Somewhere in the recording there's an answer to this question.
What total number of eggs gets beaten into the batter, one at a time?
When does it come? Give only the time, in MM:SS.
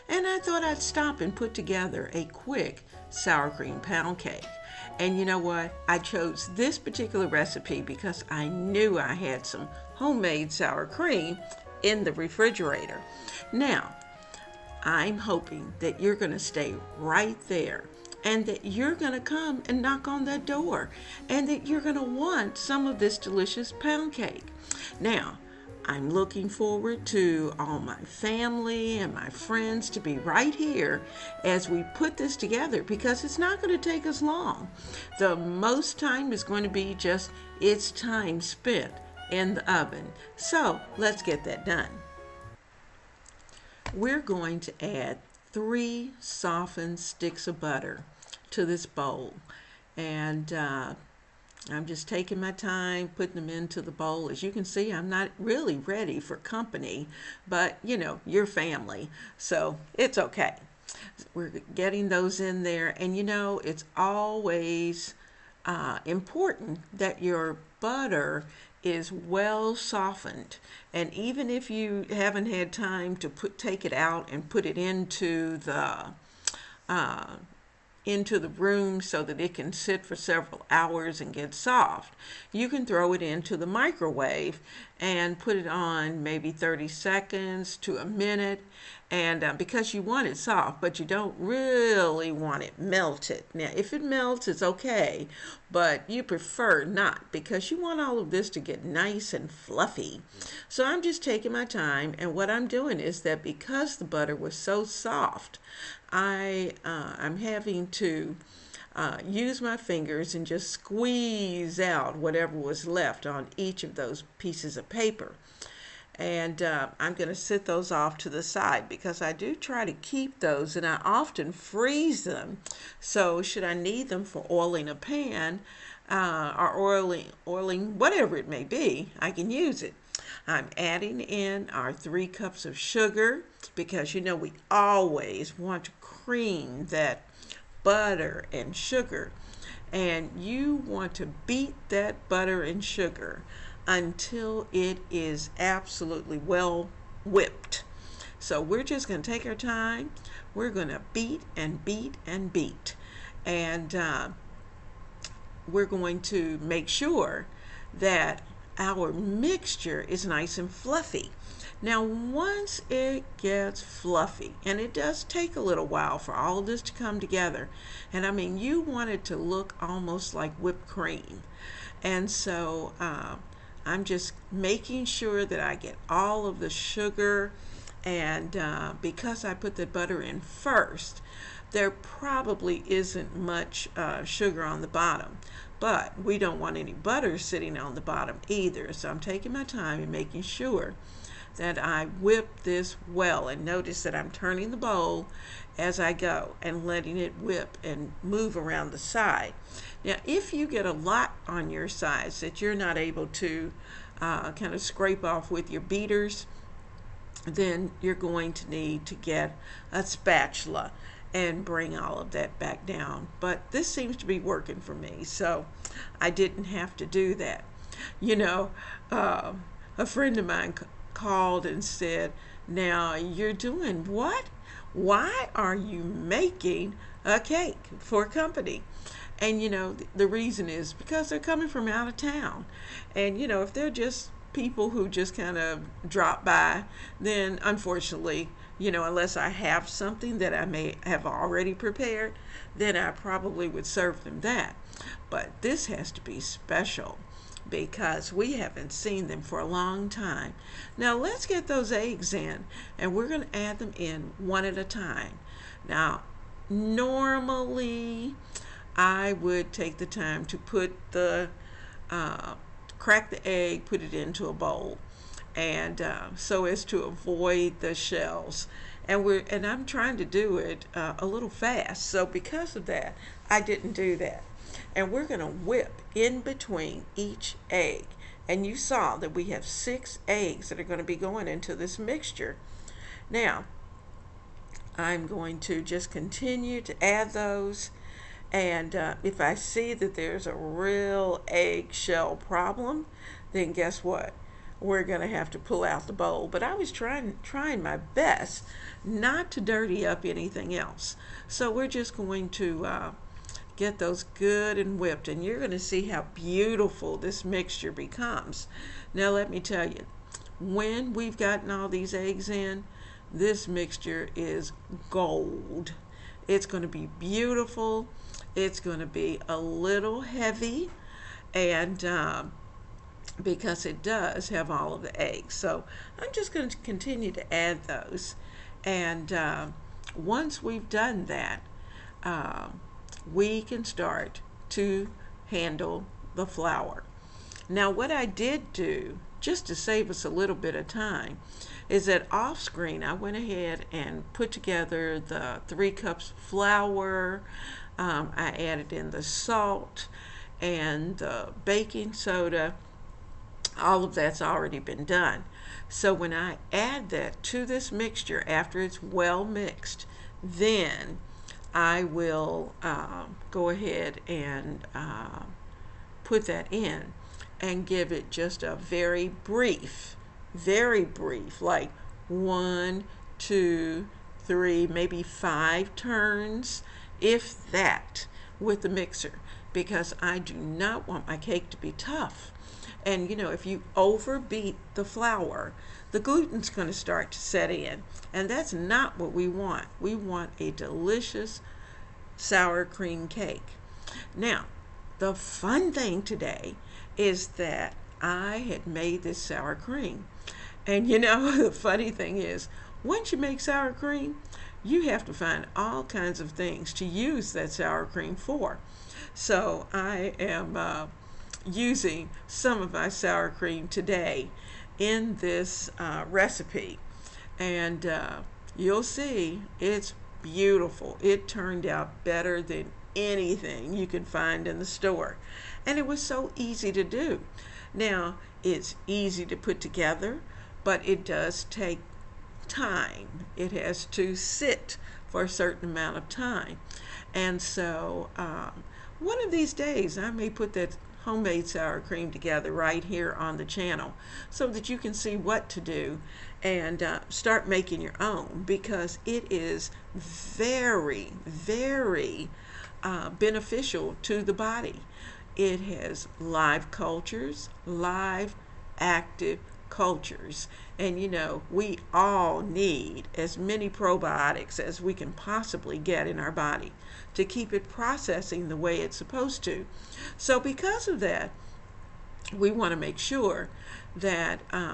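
04:39.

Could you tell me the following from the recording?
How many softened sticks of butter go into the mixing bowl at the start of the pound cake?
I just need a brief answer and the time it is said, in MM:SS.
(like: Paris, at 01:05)
3, at 00:45.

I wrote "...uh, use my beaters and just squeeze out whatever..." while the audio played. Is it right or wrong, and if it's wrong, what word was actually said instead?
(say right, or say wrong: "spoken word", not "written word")
wrong: "fingers", not "beaters".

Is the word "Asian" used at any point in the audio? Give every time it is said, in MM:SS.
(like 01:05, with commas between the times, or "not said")
not said.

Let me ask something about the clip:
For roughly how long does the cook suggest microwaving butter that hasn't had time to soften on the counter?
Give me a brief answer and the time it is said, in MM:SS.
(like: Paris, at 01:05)
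30 seconds to a minute, at 01:26.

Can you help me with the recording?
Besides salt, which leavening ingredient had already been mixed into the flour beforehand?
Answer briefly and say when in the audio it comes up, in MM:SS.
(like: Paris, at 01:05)
baking soda, at 05:51.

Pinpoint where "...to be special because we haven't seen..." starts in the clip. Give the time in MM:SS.
04:06.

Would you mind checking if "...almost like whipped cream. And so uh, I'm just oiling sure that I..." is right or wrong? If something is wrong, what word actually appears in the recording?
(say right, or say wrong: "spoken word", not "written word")
wrong: "making", not "oiling".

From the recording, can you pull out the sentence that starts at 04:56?
But I was trying, trying my best not to dirty up anything else.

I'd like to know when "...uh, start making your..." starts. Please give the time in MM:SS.
07:27.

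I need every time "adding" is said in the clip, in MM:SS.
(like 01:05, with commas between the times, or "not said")
02:10.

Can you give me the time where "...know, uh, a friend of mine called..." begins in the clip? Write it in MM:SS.
03:38.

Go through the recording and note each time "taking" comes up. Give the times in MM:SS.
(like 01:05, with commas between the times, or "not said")
00:52, 01:41, 03:09.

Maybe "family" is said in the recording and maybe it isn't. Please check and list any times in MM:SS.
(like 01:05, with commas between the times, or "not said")
00:27, 00:58.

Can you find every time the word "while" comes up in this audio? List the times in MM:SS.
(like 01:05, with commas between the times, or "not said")
02:45.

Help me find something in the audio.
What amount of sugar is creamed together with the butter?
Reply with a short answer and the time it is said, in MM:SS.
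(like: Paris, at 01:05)
3 cups, at 02:11.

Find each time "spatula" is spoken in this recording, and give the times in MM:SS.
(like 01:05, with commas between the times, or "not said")
03:30.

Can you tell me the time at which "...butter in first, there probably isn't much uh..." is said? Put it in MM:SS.
02:59.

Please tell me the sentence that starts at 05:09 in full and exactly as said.
Now, let me tell you, when we've gotten all these eggs in, this mixture is gold.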